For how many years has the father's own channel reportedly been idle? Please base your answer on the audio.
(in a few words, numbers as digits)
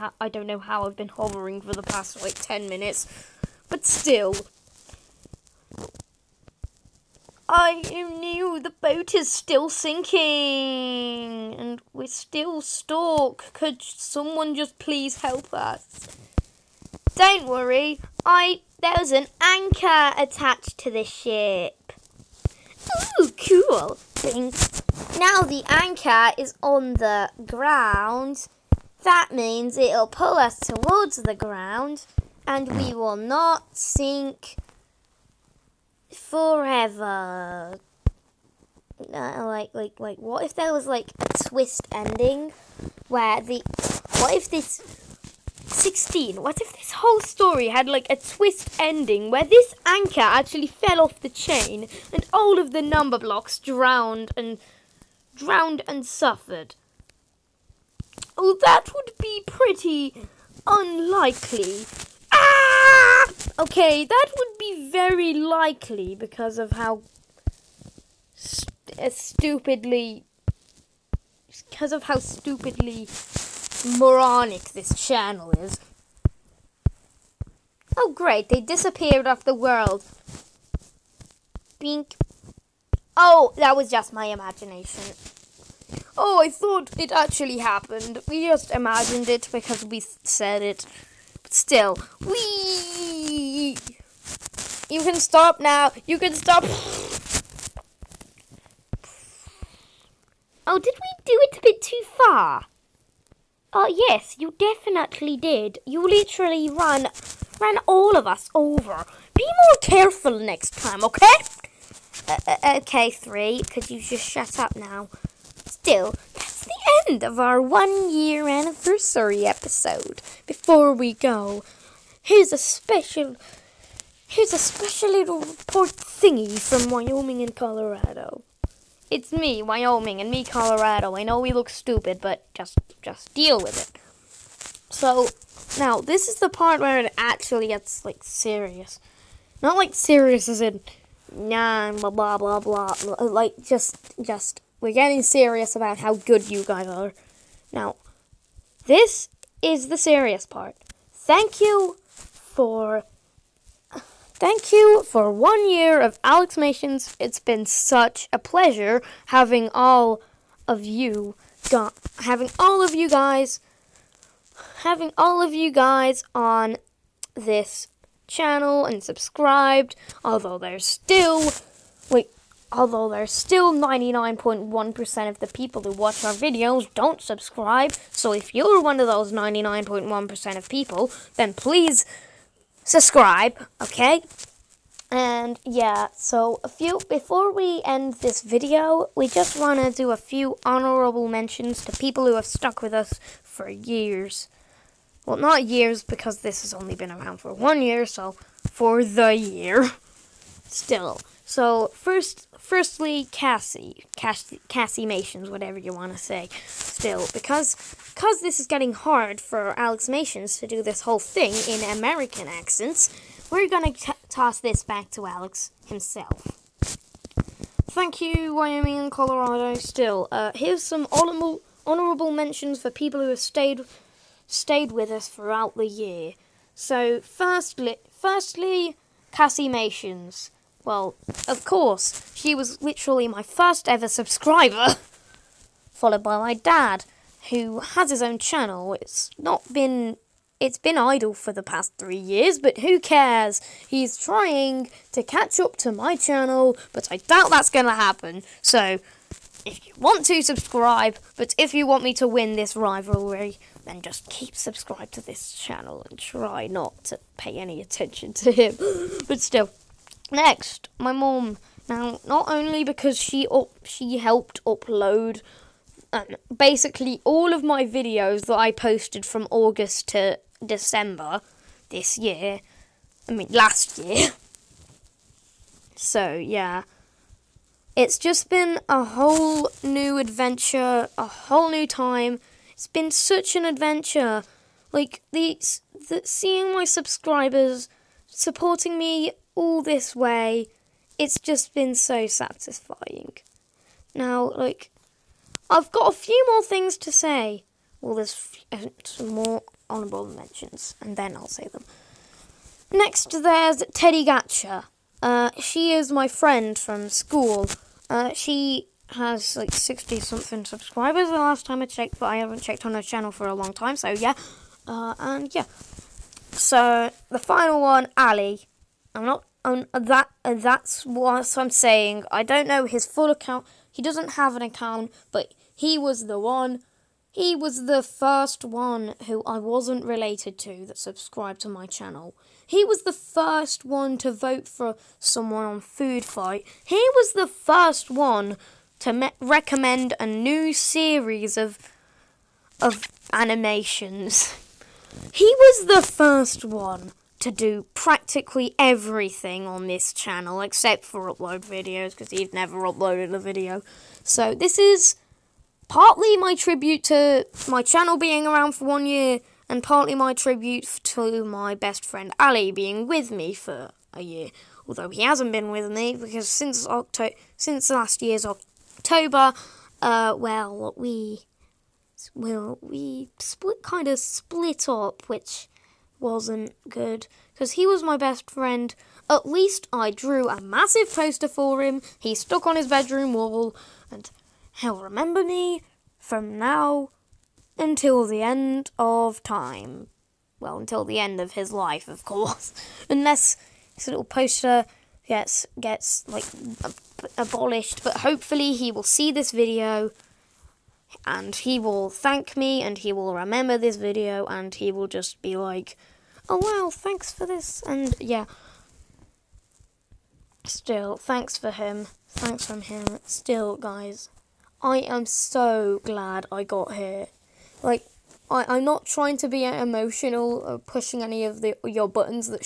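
3.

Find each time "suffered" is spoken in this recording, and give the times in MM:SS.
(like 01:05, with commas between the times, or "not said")
00:56.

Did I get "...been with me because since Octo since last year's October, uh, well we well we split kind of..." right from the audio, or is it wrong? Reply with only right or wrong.
right.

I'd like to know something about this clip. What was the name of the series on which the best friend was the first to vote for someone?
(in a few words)
Food Fight.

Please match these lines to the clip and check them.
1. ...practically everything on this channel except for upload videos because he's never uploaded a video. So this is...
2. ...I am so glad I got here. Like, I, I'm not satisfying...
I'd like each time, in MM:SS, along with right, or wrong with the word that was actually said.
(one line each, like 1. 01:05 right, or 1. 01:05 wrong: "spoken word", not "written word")
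1. 05:47 right
2. 06:54 wrong: "trying", not "satisfying".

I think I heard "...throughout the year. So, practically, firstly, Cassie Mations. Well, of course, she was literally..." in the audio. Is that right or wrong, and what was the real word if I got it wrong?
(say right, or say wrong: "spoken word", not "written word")
wrong: "firstly", not "practically".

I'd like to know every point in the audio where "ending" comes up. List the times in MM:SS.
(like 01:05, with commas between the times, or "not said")
00:41, 00:48.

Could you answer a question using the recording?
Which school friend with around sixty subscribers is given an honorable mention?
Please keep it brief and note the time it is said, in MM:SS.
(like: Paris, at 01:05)
Teddy Gatcher, at 05:03.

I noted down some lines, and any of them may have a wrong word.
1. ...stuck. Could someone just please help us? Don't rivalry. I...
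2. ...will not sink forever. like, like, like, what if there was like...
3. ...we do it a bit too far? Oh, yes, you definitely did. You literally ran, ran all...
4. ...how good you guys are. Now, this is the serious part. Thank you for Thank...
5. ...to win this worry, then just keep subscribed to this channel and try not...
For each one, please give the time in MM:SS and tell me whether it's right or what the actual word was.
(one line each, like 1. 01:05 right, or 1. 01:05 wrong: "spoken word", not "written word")
1. 00:12 wrong: "worry", not "rivalry"
2. 00:32 right
3. 01:40 right
4. 02:25 right
5. 04:12 wrong: "rivalry", not "worry".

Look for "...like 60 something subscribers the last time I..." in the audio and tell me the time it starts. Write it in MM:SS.
05:09.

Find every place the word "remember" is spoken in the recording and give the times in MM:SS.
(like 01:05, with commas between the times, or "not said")
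06:25, 06:43.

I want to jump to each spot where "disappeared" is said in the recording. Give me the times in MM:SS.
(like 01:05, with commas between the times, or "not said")
01:18.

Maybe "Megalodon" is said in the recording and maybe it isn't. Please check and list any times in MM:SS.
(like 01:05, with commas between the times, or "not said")
not said.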